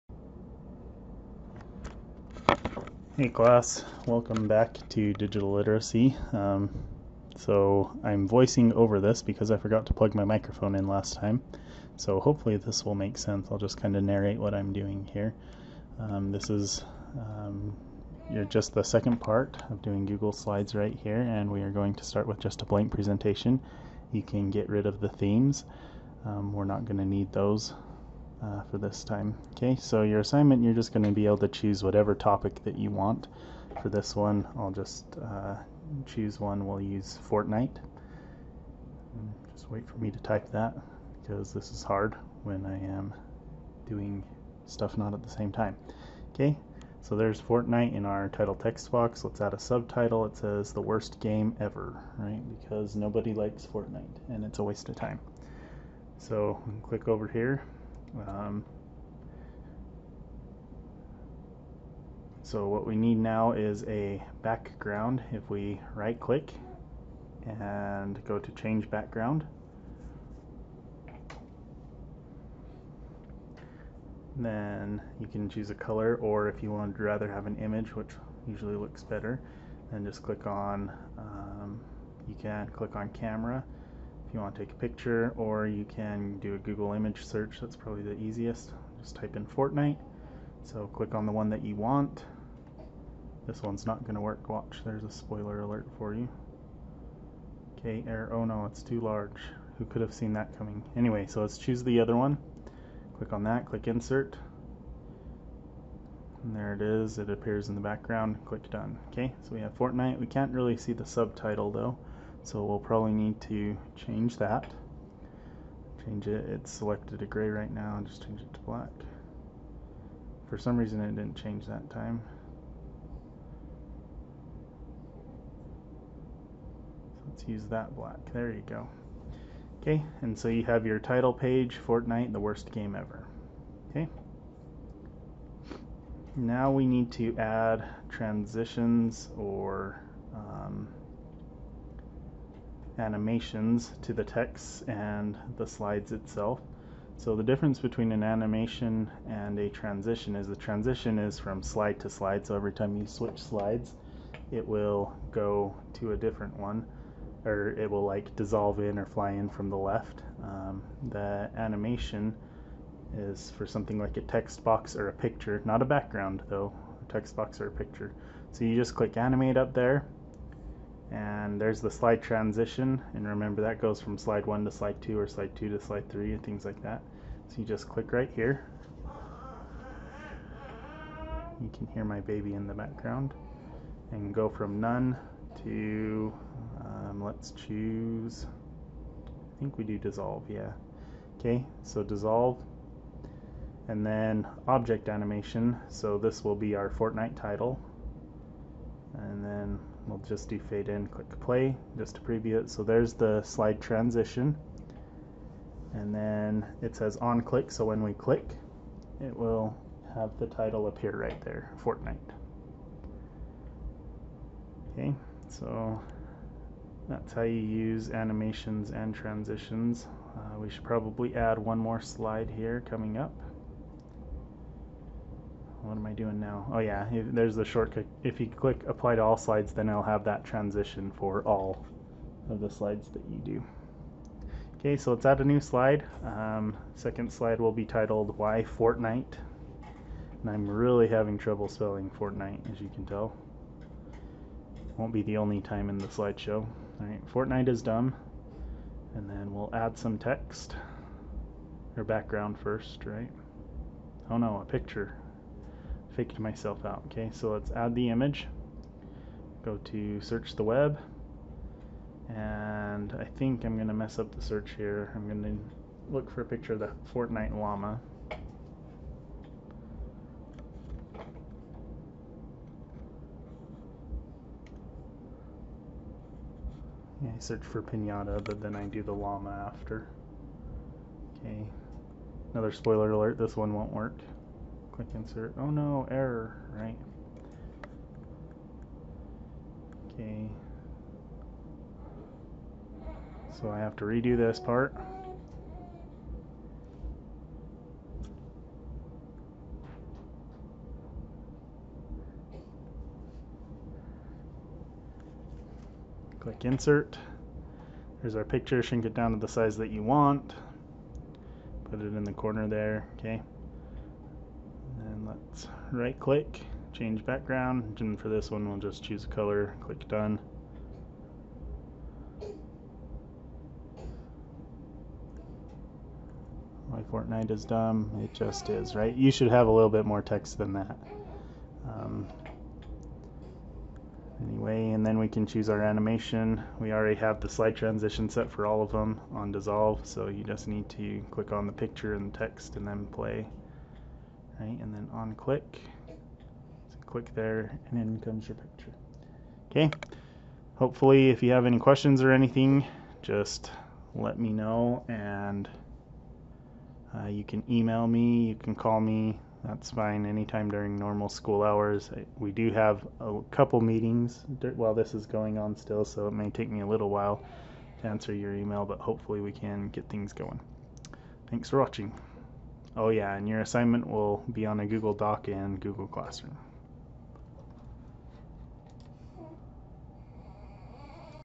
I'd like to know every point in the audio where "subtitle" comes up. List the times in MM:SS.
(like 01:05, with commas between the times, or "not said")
00:49, 01:51.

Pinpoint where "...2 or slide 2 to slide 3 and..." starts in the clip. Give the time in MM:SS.
02:55.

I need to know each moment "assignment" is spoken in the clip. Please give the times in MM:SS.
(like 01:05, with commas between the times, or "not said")
00:30, 06:13.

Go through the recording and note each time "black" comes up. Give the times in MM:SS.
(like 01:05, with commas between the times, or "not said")
01:58, 02:07.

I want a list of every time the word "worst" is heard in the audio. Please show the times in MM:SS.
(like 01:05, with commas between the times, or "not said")
00:50, 02:12.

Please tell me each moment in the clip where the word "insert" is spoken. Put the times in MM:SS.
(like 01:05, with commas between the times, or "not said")
01:43, 04:45, 05:06.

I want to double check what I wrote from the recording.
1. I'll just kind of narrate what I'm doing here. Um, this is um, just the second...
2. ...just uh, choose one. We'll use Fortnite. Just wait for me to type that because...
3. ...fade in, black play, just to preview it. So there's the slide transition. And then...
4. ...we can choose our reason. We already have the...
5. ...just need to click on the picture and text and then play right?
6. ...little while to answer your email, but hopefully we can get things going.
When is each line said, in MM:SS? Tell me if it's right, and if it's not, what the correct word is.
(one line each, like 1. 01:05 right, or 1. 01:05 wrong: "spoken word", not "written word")
1. 00:13 right
2. 00:34 right
3. 03:20 wrong: "click", not "black"
4. 05:35 wrong: "animation", not "reason"
5. 05:40 right
6. 06:06 right.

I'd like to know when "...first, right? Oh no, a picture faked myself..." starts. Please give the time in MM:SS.
04:12.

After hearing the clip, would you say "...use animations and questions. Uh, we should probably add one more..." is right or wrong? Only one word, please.
wrong.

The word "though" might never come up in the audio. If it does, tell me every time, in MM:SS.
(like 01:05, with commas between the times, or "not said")
01:51, 02:46.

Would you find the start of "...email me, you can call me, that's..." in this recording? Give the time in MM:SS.
05:57.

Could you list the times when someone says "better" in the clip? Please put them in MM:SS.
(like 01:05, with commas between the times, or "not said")
01:19.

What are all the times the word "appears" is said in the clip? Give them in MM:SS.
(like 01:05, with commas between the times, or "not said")
01:47, 03:30.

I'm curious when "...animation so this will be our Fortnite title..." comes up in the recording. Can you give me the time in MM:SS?
03:15.